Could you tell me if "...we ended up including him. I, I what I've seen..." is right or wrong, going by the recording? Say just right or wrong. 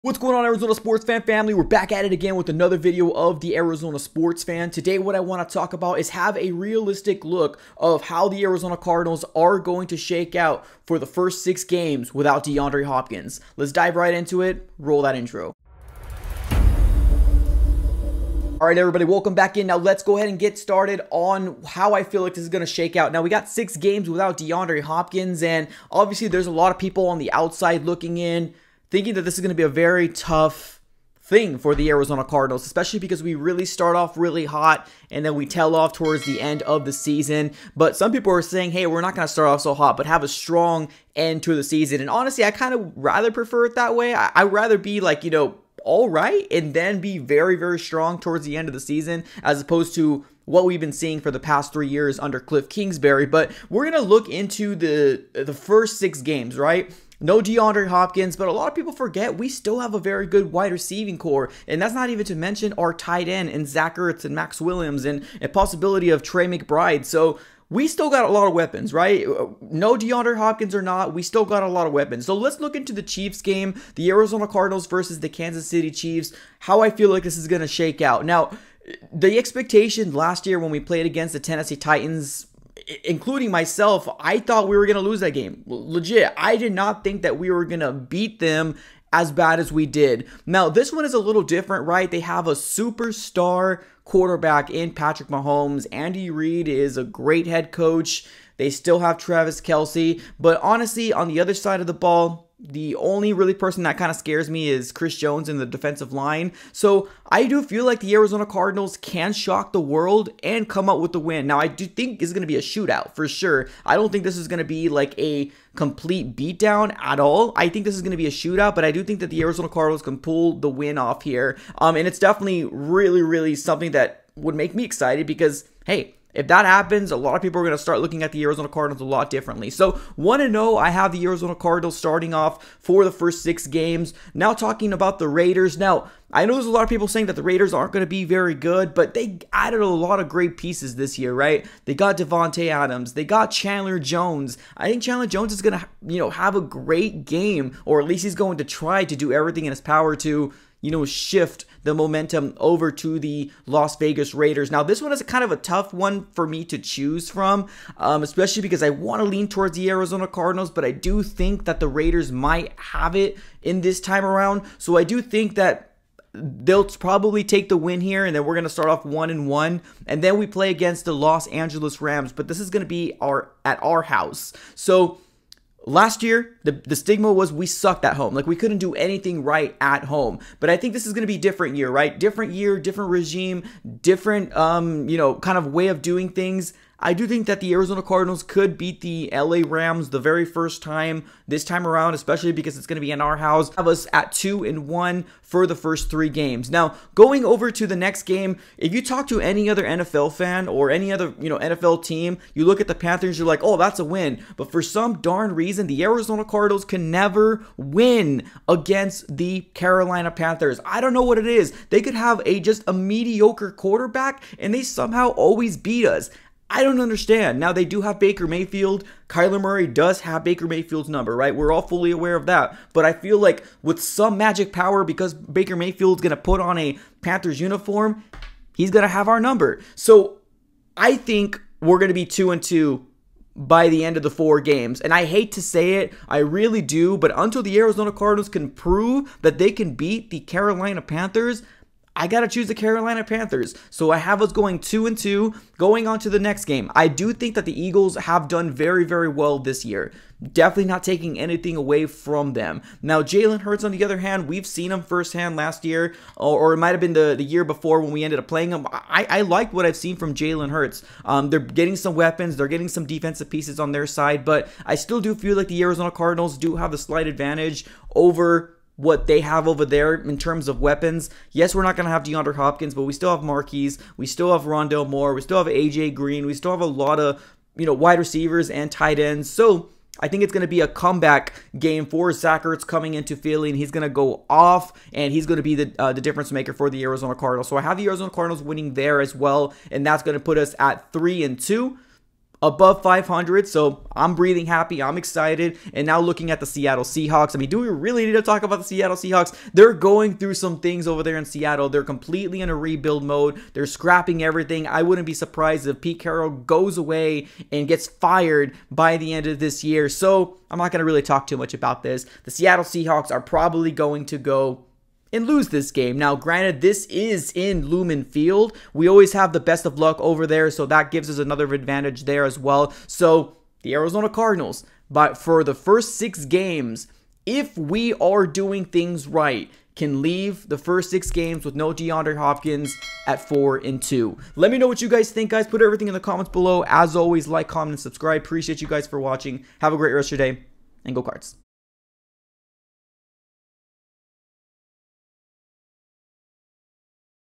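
wrong.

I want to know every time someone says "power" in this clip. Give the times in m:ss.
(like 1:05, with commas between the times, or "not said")
2:29, 3:44.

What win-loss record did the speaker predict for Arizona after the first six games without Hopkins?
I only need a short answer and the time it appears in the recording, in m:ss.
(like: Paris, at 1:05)
4-2, at 5:33.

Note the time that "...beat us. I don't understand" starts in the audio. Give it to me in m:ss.
3:35.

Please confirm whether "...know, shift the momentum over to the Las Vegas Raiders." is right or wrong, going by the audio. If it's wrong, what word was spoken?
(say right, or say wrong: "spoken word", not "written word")
right.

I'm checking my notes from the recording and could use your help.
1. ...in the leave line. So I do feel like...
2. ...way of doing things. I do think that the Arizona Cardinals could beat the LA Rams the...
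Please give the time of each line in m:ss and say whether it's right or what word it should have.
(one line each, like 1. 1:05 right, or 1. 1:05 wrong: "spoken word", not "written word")
1. 1:45 wrong: "defensive", not "leave"
2. 3:05 right.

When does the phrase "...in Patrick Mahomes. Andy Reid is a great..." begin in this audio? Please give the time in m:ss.
1:34.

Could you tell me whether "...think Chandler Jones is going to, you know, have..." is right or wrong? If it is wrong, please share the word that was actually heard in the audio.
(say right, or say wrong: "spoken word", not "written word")
right.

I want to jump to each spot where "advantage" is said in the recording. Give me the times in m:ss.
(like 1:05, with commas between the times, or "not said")
4:27, 5:21.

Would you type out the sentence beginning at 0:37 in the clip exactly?
But some people are saying, hey, we're not going to start off so hot, but have a strong end to the season.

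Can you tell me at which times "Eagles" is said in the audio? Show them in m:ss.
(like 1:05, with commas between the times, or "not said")
4:07.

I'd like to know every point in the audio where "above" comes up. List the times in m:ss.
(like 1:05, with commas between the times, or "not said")
4:52.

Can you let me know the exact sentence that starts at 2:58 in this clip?
Like we couldn't do anything right at home.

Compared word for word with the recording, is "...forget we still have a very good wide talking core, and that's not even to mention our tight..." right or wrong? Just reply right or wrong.
wrong.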